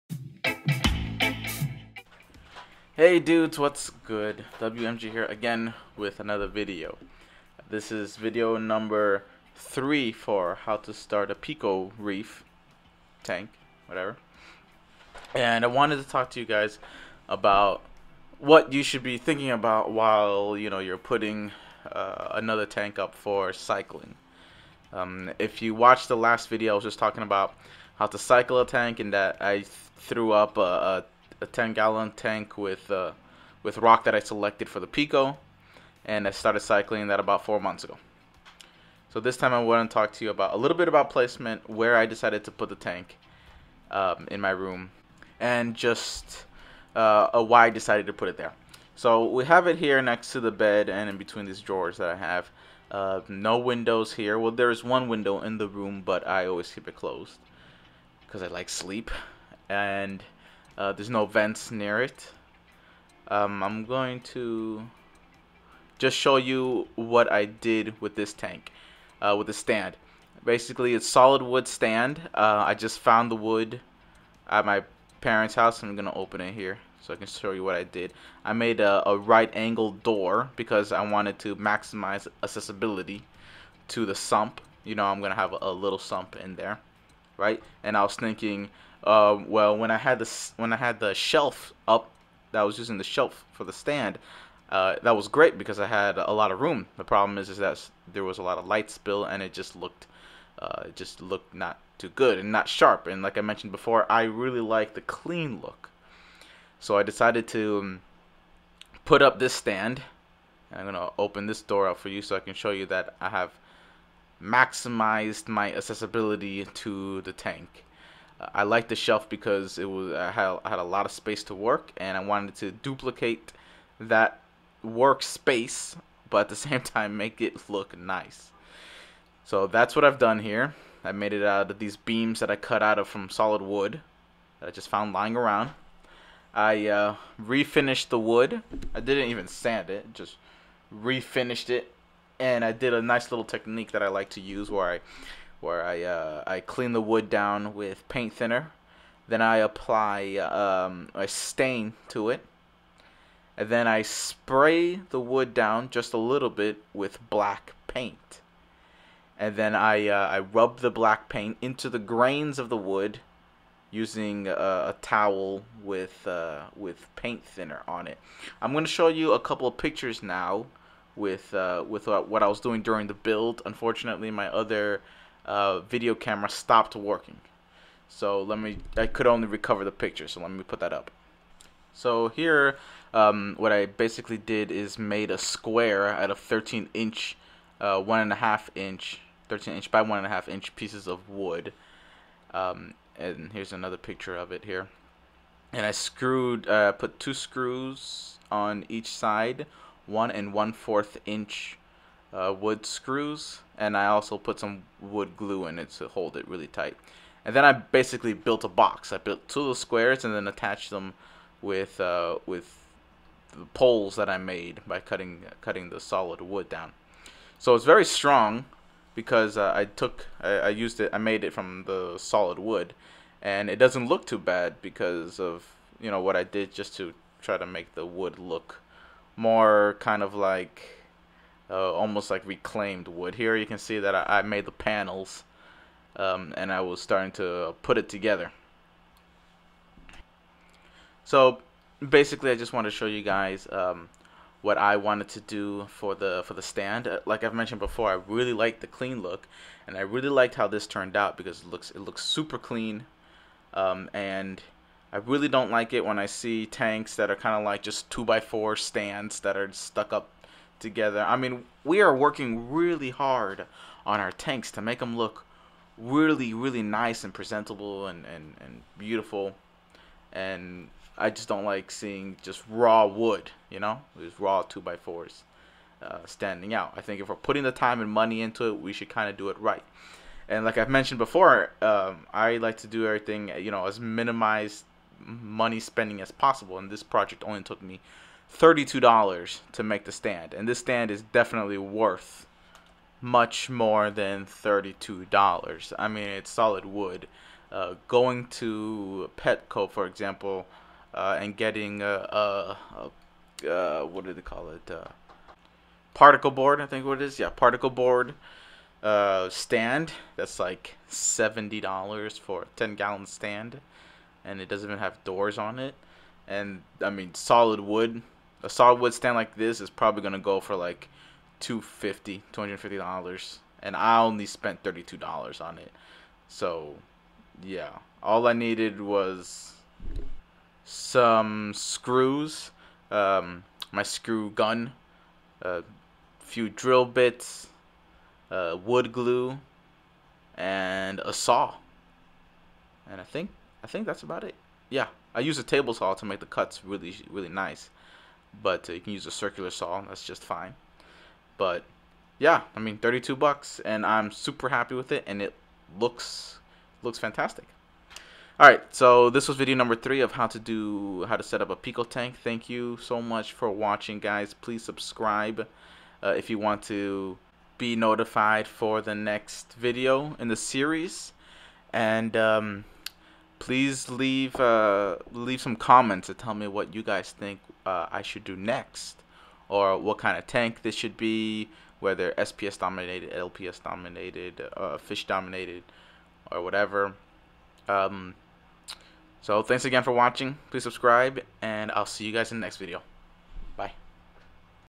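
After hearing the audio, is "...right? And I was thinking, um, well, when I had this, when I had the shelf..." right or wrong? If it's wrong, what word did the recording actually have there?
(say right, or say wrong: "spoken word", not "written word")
right.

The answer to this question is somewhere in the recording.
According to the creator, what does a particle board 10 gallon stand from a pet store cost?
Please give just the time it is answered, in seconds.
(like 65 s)
311 s.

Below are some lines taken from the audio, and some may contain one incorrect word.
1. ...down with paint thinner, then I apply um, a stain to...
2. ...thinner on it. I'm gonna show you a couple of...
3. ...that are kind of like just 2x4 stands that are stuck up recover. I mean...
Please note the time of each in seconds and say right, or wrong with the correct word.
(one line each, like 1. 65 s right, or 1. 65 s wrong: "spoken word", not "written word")
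1. 147 s right
2. 167 s right
3. 257 s wrong: "together", not "recover".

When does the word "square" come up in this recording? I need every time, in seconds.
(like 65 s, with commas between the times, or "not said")
185 s, 209 s.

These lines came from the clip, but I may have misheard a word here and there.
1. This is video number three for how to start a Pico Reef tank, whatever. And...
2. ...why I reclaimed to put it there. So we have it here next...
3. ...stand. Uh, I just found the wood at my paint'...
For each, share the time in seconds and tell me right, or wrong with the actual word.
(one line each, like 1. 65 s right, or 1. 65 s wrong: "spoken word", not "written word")
1. 7 s right
2. 47 s wrong: "decided", not "reclaimed"
3. 71 s wrong: "parents", not "paint".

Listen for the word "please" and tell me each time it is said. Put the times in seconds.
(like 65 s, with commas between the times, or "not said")
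364 s, 373 s, 390 s.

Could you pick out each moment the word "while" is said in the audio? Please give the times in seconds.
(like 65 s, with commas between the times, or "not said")
19 s.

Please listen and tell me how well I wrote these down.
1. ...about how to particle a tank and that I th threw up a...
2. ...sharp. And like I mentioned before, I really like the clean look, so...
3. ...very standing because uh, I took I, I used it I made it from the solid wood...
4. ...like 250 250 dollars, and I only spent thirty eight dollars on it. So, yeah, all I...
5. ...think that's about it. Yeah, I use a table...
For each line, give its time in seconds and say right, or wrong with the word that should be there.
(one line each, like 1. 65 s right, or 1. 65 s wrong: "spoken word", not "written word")
1. 27 s wrong: "cycle", not "particle"
2. 102 s right
3. 217 s wrong: "strong", not "standing"
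4. 320 s wrong: "two", not "eight"
5. 343 s right.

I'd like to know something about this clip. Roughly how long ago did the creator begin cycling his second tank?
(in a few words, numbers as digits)
four months.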